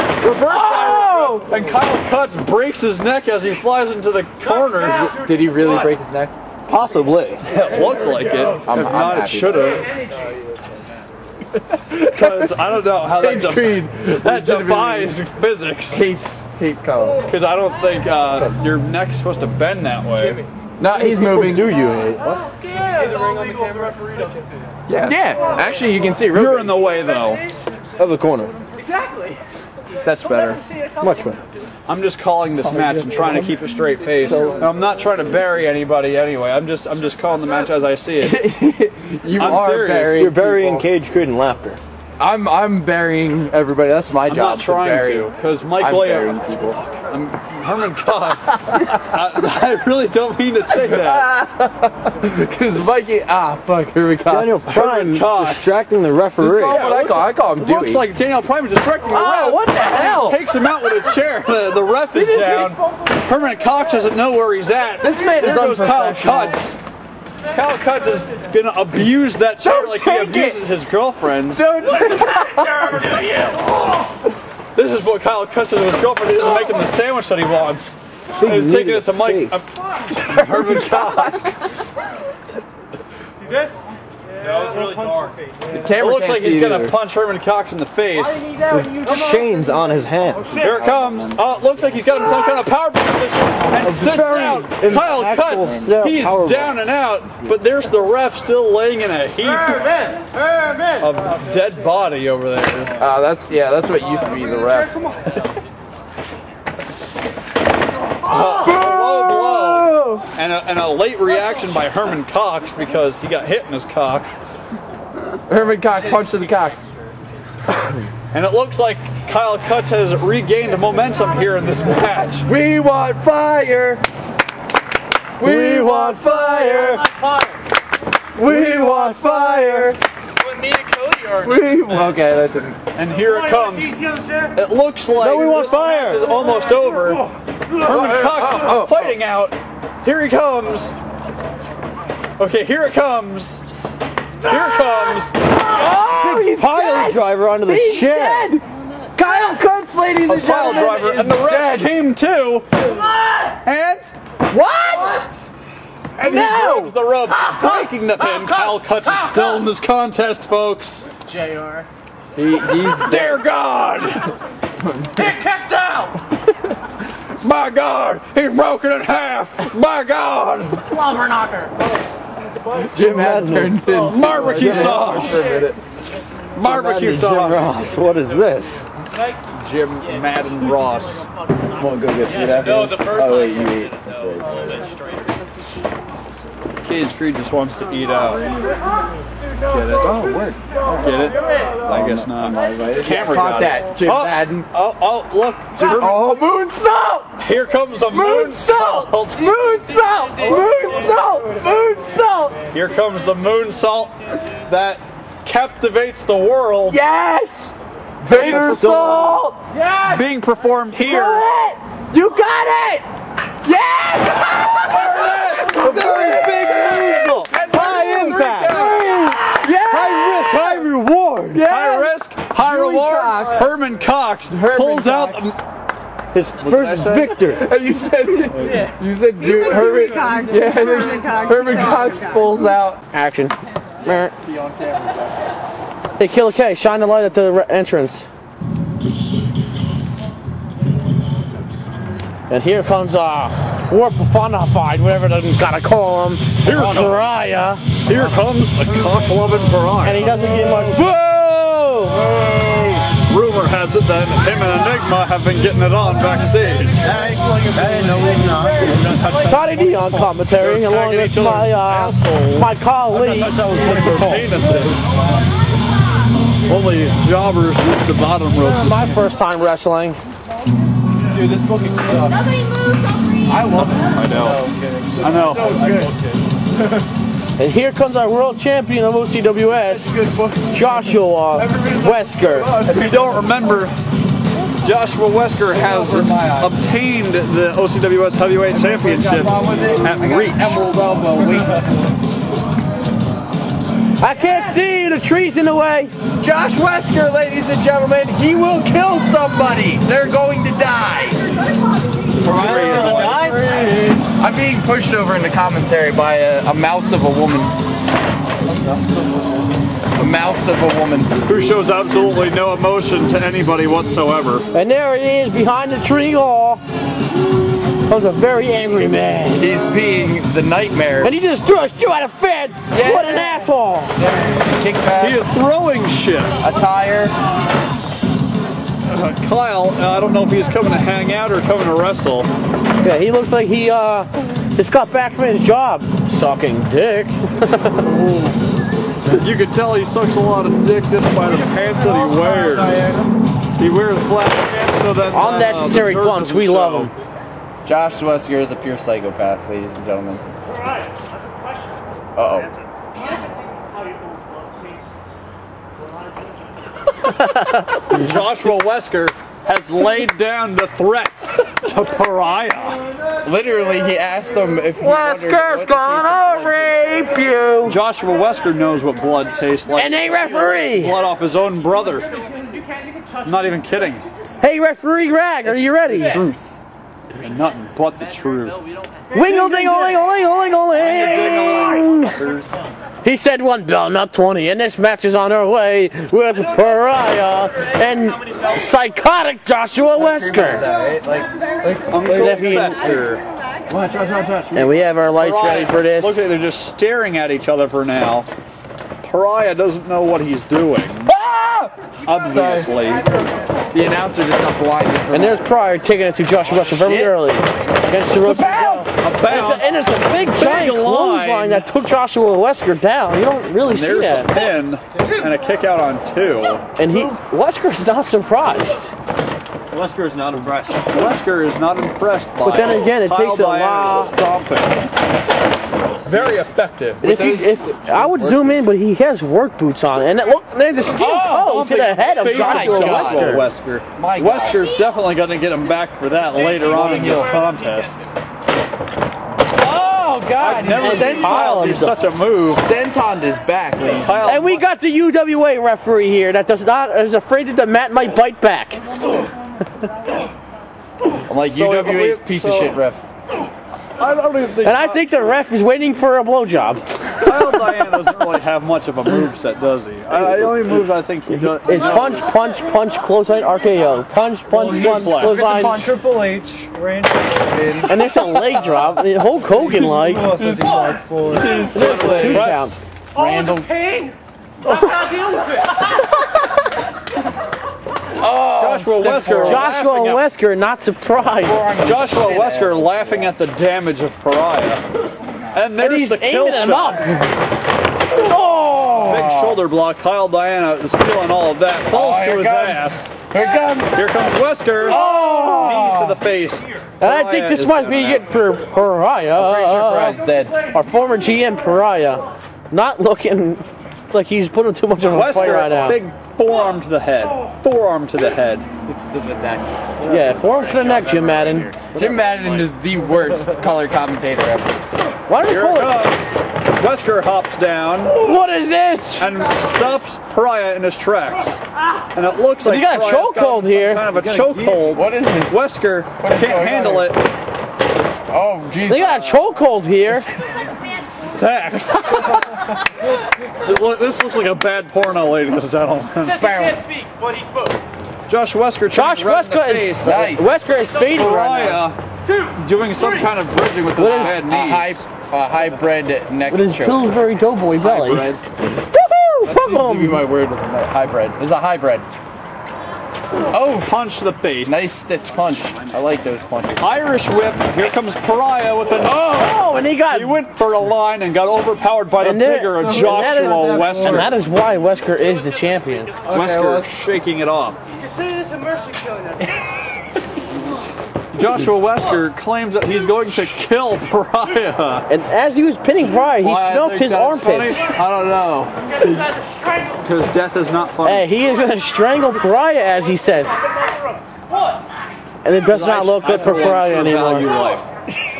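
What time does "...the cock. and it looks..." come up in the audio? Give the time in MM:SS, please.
01:56.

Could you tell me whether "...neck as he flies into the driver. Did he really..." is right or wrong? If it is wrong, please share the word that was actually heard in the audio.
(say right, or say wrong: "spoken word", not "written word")
wrong: "corner", not "driver".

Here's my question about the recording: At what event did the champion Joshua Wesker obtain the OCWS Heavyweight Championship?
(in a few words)
Reach.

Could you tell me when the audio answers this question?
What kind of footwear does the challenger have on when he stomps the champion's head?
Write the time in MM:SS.
07:09.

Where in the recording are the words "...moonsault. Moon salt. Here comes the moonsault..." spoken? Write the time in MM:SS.
03:18.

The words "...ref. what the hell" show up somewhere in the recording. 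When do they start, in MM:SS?
00:59.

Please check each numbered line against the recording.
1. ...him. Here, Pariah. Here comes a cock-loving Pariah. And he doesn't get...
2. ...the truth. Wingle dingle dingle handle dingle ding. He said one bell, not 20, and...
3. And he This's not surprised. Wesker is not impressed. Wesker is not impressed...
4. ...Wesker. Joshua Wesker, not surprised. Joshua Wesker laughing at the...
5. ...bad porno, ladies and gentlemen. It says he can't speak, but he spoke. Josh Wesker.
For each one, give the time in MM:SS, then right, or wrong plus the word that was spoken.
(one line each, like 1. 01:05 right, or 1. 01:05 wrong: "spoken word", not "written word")
1. 04:06 right
2. 06:18 wrong: "dingle", not "handle"
3. 06:57 wrong: "Wesker", not "This"
4. 07:59 right
5. 08:54 right.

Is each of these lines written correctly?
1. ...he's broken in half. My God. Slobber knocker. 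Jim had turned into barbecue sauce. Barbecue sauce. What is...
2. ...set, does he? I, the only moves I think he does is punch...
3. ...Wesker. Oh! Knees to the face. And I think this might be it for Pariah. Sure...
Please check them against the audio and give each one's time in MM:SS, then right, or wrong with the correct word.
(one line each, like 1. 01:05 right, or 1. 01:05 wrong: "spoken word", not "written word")
1. 02:48 right
2. 07:39 right
3. 08:14 right.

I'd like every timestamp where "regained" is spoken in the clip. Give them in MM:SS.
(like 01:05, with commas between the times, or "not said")
02:00.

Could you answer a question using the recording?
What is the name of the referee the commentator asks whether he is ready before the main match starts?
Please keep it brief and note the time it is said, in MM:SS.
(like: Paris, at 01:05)
Greg, at 06:14.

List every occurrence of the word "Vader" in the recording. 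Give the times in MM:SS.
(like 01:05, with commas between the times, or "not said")
03:28.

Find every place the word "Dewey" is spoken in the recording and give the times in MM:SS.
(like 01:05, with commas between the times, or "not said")
00:57, 03:42, 03:49.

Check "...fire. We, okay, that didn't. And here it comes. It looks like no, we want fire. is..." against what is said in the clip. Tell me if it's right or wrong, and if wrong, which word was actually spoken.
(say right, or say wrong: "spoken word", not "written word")
right.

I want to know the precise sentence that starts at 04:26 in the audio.
Only jobbers at the bottom rope.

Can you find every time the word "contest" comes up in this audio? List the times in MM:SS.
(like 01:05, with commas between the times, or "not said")
02:39, 07:17.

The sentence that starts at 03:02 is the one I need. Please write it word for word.
no, the first Oh, wait, you eat.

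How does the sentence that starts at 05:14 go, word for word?
And there he is behind the tree wall.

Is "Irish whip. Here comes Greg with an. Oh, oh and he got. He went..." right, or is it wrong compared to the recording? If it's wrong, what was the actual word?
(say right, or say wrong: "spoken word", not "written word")
wrong: "Pariah", not "Greg".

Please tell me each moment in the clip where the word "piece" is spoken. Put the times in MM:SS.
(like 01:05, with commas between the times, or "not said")
07:32.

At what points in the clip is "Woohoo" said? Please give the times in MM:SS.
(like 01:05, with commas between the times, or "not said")
09:08.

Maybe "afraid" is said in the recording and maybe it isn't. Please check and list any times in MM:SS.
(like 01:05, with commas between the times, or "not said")
07:27.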